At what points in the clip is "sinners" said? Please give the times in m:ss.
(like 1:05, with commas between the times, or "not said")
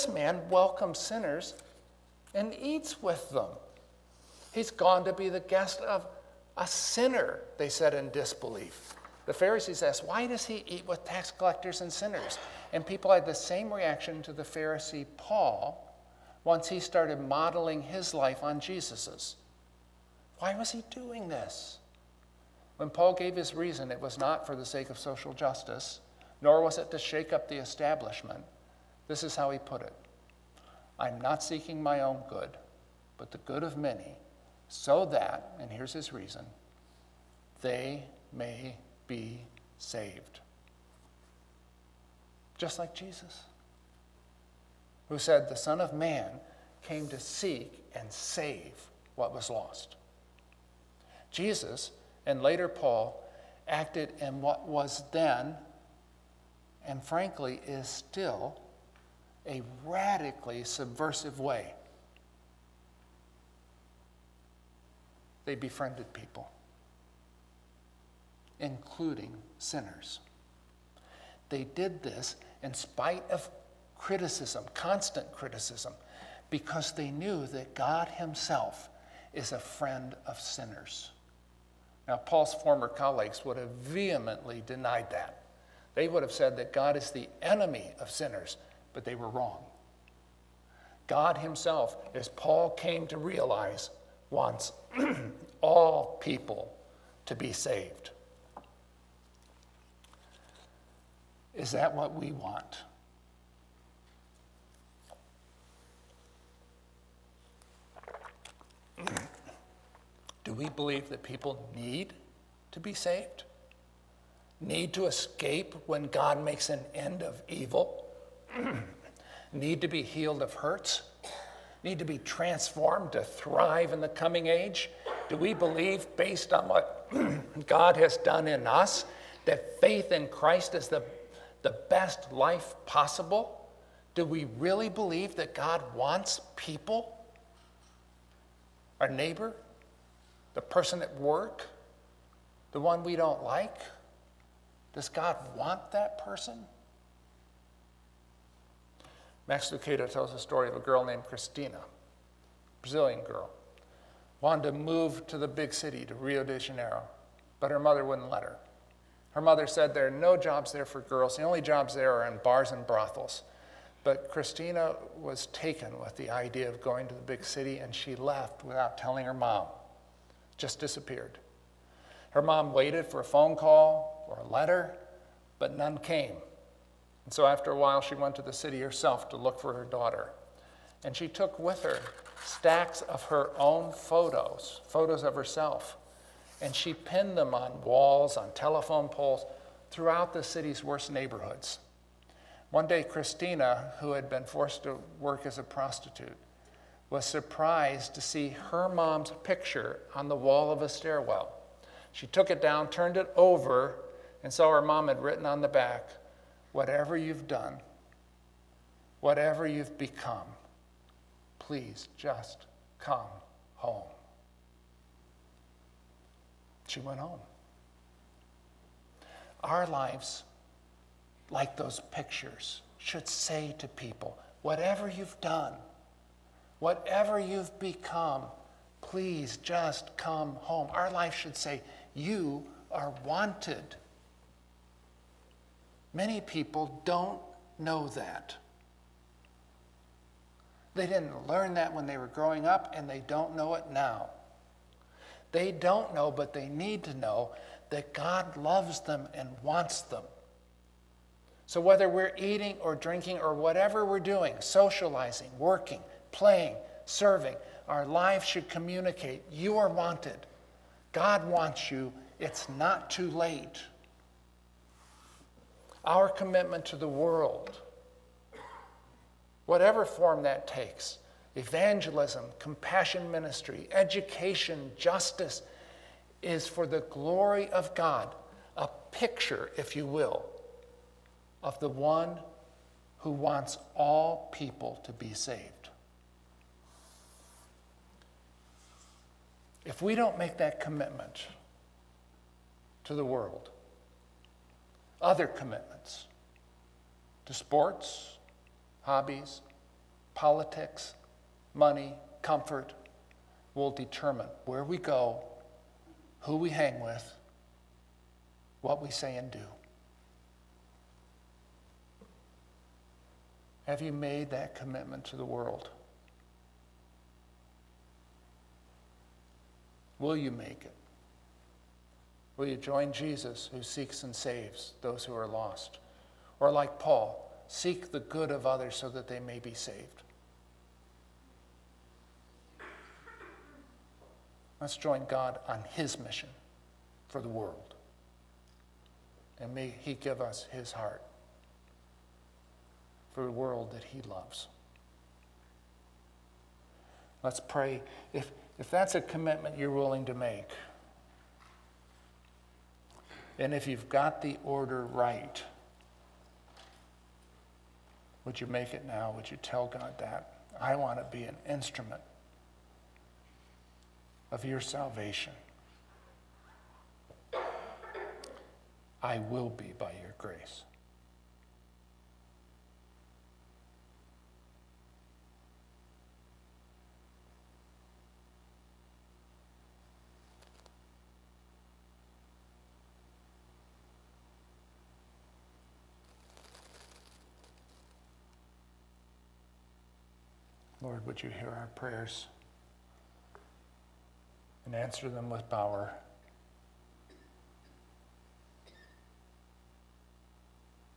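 0:00, 0:06, 0:11, 1:09, 1:20, 1:28.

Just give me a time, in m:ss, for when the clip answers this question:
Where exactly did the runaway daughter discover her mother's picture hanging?
3:20.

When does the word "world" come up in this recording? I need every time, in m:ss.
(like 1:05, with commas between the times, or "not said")
4:27, 4:53, 5:15, 5:37, 5:43.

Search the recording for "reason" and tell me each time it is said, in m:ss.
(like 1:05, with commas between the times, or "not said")
0:23, 0:36.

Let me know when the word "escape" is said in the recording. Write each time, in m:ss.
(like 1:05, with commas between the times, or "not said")
1:55.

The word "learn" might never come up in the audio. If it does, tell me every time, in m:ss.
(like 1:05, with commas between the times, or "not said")
4:01.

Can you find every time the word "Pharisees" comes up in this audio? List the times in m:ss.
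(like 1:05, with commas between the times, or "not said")
0:09, 0:14.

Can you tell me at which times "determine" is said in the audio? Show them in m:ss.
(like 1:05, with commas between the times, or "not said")
5:03.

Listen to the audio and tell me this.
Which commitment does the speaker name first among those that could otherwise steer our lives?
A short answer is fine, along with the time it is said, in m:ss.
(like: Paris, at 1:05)
Sports, at 4:57.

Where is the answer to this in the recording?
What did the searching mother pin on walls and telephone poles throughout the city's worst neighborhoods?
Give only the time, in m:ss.
3:04.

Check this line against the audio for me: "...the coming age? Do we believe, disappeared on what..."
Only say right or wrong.
wrong.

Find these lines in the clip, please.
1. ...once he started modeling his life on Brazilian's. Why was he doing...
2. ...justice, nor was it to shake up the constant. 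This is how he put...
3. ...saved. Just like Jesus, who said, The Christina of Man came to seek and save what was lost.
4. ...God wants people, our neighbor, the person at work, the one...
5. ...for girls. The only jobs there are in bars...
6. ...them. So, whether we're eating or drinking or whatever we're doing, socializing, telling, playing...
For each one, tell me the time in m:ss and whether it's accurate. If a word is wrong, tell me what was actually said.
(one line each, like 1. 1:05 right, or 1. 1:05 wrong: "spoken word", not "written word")
1. 0:16 wrong: "Jesus", not "Brazilian"
2. 0:25 wrong: "establishment", not "constant"
3. 0:39 wrong: "Son", not "Christina"
4. 2:15 right
5. 2:40 right
6. 4:10 wrong: "working", not "telling".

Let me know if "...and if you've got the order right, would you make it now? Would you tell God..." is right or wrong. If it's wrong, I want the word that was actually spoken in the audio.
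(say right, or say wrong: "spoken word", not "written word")
right.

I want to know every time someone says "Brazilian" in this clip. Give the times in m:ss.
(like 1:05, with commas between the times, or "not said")
2:32.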